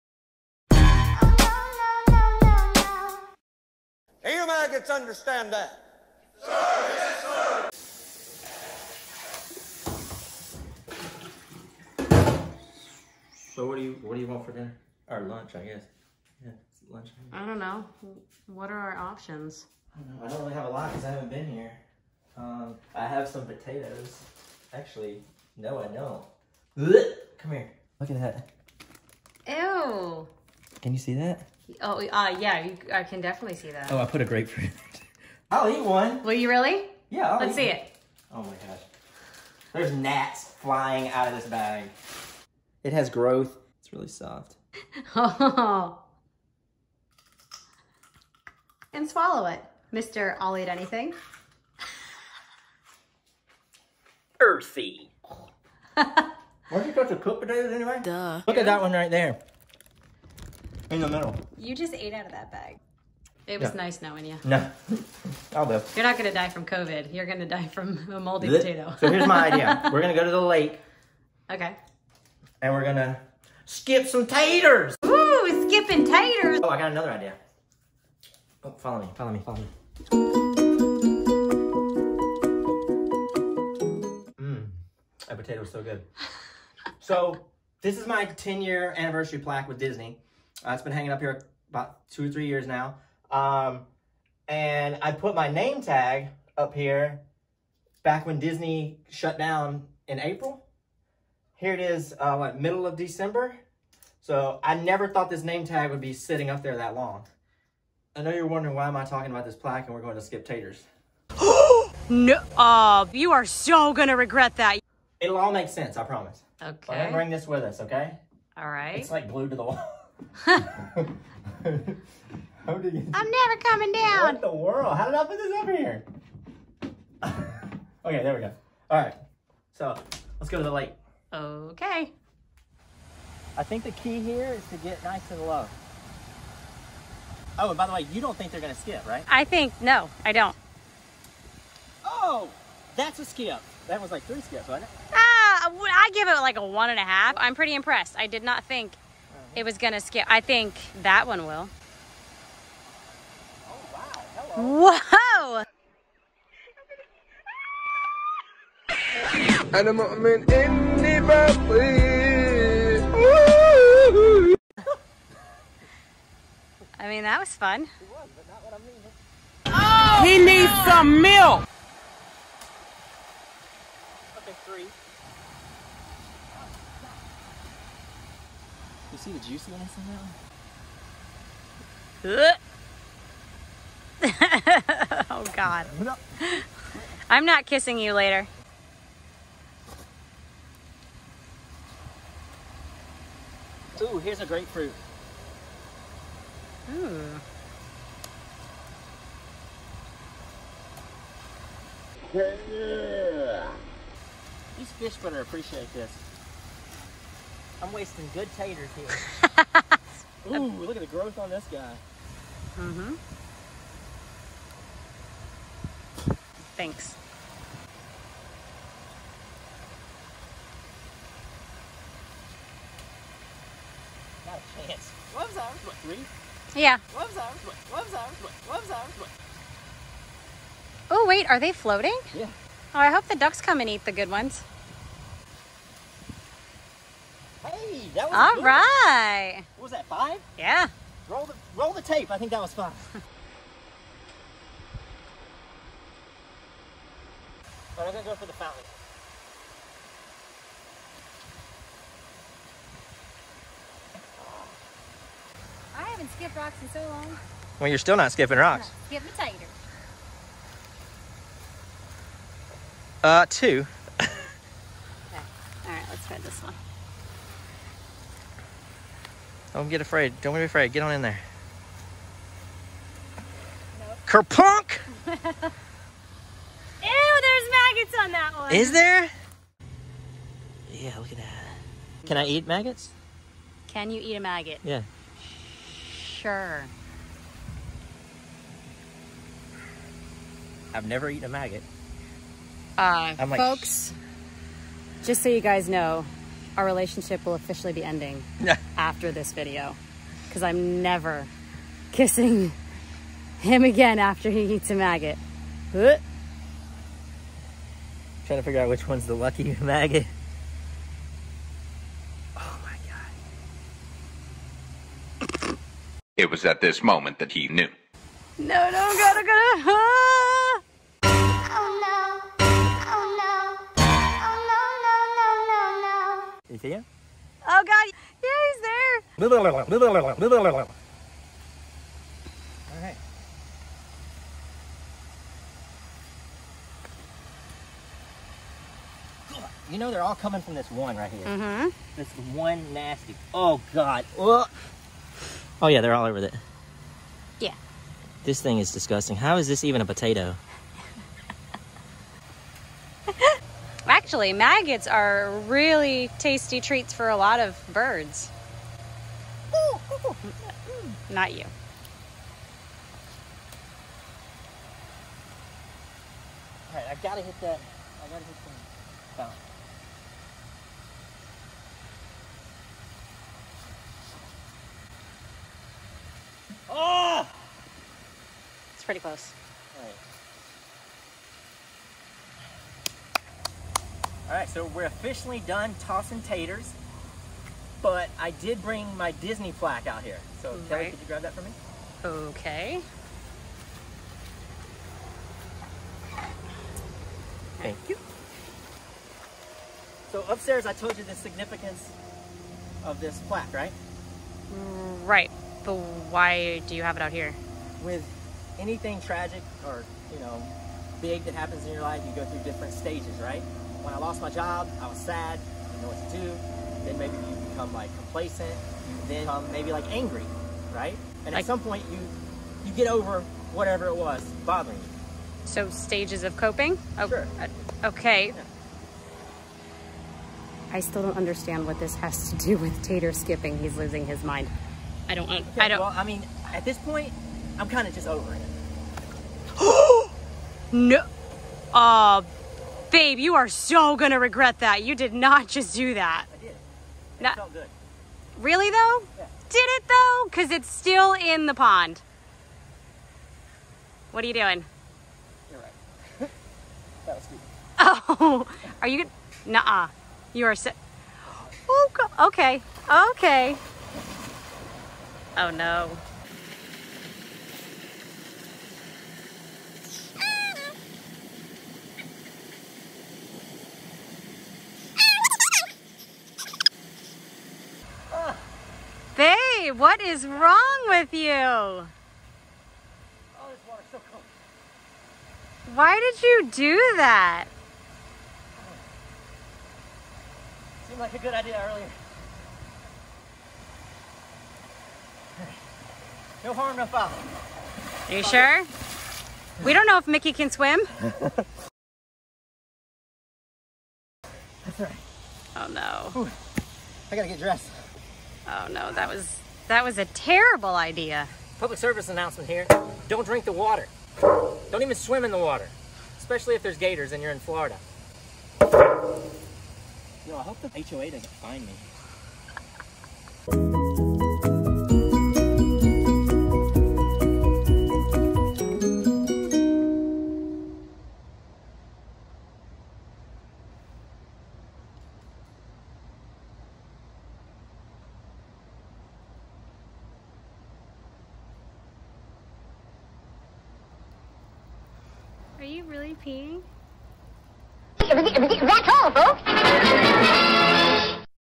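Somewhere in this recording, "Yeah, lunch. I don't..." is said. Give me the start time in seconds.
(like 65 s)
16 s.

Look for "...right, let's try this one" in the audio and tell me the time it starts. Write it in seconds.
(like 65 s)
265 s.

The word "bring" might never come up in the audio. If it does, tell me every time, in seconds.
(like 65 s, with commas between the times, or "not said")
117 s, 388 s.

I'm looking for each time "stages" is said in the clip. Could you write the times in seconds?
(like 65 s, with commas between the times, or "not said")
412 s, 425 s.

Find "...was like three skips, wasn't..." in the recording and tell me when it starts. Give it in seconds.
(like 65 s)
144 s.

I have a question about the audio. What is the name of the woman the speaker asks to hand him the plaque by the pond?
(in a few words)
Kelly.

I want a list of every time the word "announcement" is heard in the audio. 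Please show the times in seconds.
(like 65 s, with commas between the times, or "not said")
512 s.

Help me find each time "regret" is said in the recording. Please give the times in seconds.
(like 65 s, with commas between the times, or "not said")
114 s, 444 s.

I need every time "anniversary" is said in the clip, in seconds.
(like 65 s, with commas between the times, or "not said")
88 s.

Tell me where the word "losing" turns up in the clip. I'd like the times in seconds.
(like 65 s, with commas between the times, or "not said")
433 s.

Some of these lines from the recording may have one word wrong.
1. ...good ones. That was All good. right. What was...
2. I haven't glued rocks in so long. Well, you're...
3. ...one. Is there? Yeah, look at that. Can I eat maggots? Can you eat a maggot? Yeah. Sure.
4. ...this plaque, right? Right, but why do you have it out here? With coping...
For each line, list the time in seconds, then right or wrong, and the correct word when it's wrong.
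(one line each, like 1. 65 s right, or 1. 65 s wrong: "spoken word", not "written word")
1. 234 s right
2. 255 s wrong: "skipped", not "glued"
3. 278 s right
4. 403 s wrong: "anything", not "coping".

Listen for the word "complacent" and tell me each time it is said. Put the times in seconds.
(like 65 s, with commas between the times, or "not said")
418 s.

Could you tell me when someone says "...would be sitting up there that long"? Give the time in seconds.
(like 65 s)
105 s.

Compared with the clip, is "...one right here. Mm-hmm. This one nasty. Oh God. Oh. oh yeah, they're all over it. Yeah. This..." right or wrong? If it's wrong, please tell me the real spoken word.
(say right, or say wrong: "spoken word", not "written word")
right.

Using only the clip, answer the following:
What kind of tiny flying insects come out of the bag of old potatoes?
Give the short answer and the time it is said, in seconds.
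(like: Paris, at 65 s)
Gnats, at 39 s.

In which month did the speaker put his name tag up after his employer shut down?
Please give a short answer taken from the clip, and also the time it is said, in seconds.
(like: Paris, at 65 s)
April, at 100 s.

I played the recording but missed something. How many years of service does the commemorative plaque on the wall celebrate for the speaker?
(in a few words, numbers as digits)
10.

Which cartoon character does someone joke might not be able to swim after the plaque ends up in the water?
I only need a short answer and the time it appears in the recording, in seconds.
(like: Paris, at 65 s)
Mickey, at 500 s.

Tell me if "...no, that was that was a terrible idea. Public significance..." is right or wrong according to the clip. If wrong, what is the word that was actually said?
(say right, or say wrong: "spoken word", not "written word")
wrong: "service", not "significance".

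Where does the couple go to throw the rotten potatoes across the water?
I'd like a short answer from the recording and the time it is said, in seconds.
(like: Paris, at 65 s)
The lake, at 70 s.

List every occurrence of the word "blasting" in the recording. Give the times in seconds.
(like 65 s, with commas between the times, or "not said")
not said.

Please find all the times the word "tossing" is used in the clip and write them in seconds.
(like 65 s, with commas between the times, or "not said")
385 s.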